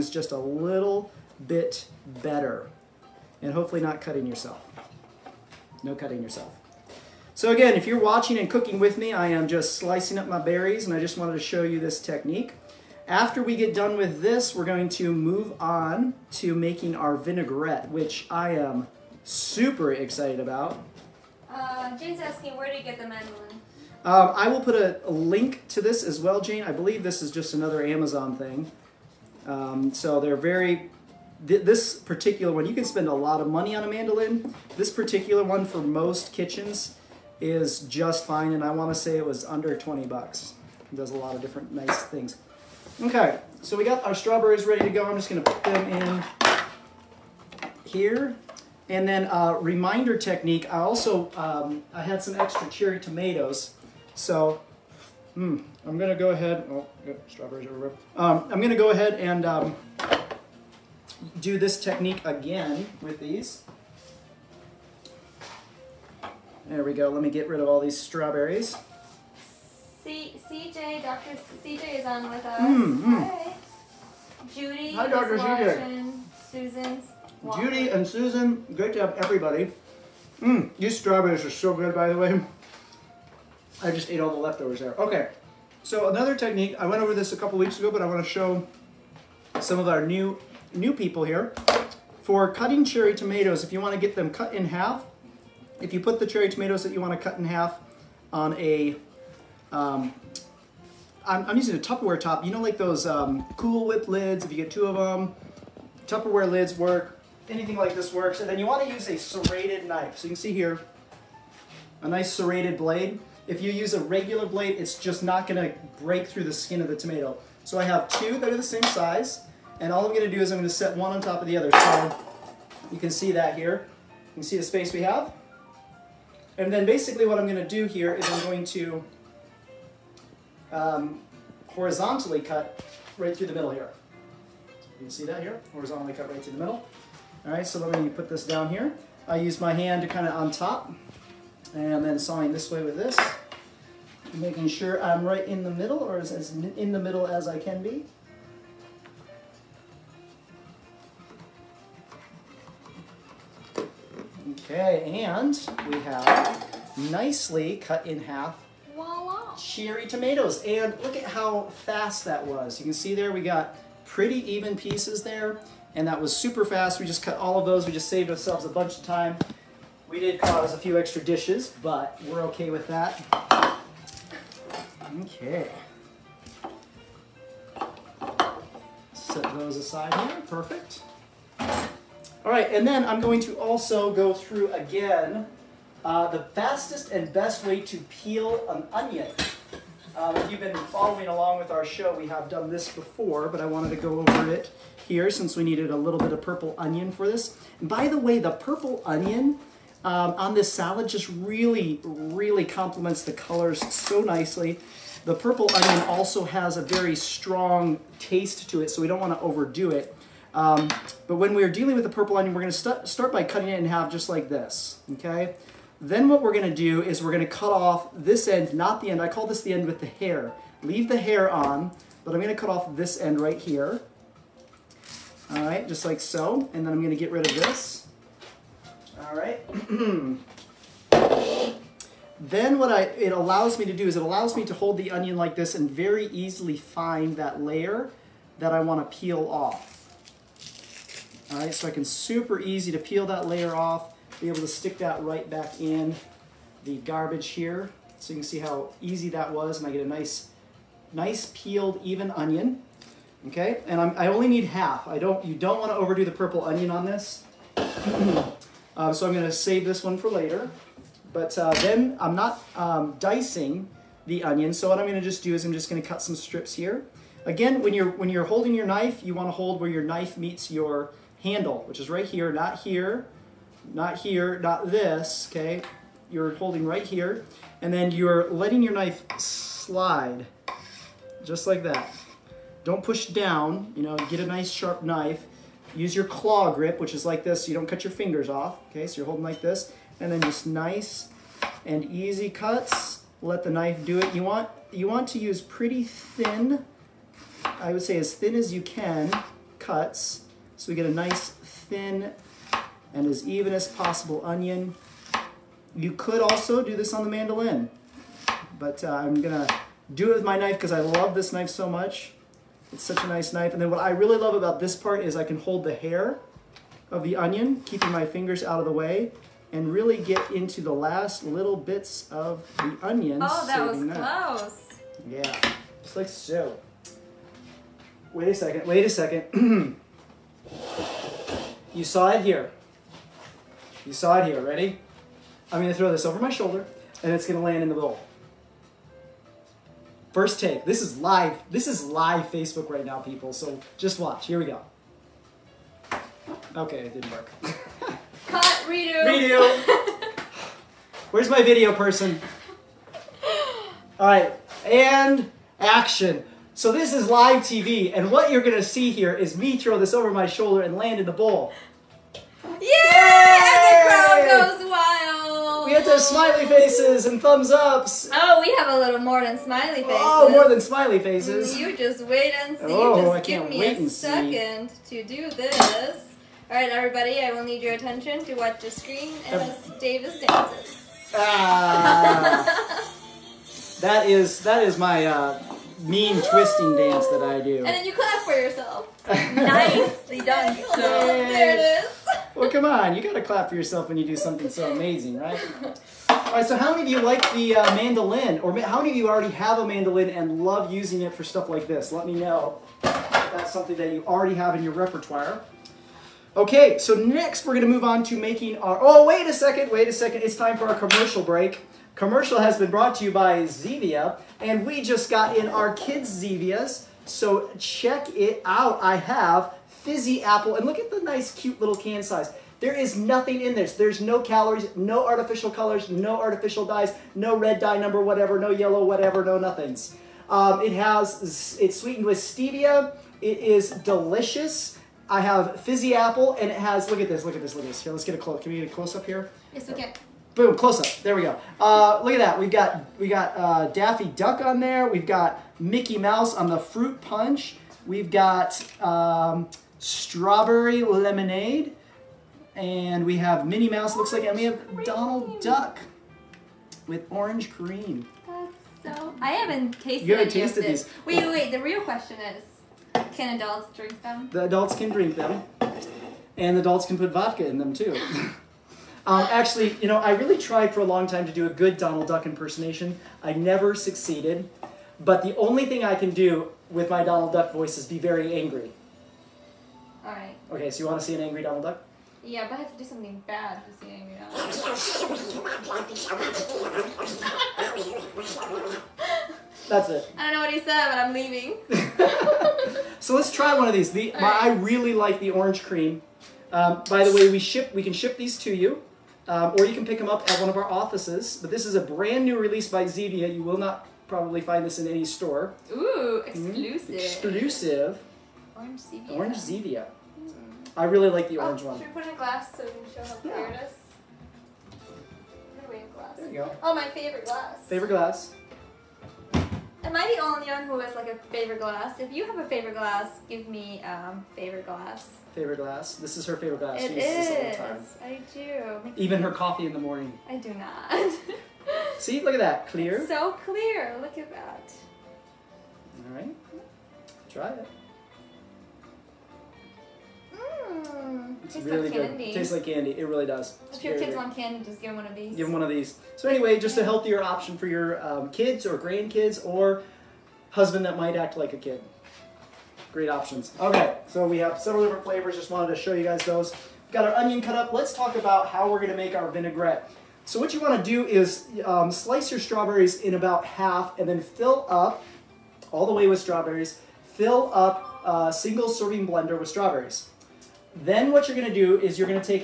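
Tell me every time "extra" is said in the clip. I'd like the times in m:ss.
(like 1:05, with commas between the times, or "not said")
0:52, 2:50.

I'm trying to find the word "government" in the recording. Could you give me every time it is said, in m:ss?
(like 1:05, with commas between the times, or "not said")
not said.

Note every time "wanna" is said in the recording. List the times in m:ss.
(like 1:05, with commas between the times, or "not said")
3:58, 4:15, 4:29, 9:20.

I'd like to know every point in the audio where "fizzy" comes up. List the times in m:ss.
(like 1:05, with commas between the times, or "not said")
7:00, 7:15.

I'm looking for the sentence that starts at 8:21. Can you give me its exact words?
But this is a brand new release by Zevia.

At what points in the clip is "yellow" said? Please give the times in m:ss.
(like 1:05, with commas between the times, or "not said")
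7:08.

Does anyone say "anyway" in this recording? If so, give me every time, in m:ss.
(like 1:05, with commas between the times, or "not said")
9:06.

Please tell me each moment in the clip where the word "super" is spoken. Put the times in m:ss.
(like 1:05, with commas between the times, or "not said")
0:19, 2:46, 4:02.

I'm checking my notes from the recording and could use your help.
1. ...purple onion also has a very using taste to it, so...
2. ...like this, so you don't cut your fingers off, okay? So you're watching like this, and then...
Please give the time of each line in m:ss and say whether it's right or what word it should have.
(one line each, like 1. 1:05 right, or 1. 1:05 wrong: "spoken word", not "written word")
1. 3:25 wrong: "strong", not "using"
2. 4:47 wrong: "holding", not "watching".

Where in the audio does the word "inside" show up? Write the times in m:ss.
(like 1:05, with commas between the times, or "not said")
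not said.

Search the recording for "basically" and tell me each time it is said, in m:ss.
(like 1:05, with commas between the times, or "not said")
2:06.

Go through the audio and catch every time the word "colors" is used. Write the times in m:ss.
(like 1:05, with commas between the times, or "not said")
3:23, 7:05.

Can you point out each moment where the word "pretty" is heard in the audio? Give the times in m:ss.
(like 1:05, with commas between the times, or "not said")
2:44, 4:55.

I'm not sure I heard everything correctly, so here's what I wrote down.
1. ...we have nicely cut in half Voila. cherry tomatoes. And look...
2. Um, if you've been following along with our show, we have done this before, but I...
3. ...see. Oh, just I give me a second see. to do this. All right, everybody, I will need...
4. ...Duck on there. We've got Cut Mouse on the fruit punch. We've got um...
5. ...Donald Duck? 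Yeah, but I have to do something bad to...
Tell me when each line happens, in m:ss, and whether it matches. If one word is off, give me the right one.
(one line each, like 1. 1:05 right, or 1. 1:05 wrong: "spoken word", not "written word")
1. 2:35 right
2. 3:10 right
3. 6:12 right
4. 7:24 wrong: "Mickey", not "Cut"
5. 8:01 right.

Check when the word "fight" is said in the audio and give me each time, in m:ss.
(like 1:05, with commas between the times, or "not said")
not said.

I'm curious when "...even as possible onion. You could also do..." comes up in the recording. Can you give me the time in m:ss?
5:03.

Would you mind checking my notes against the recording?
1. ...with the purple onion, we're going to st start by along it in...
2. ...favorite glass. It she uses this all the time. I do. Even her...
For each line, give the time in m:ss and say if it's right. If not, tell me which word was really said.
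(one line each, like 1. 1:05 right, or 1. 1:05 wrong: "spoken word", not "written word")
1. 3:31 wrong: "cutting", not "along"
2. 8:46 right.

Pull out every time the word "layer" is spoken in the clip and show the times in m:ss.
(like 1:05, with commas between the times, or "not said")
3:57, 4:03.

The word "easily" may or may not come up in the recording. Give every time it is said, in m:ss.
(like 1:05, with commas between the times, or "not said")
3:56.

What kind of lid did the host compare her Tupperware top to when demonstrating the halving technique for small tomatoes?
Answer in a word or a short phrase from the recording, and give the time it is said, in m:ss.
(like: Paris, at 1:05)
Cool Whip lids, at 1:43.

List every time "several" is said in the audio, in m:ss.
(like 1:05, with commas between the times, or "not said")
9:14.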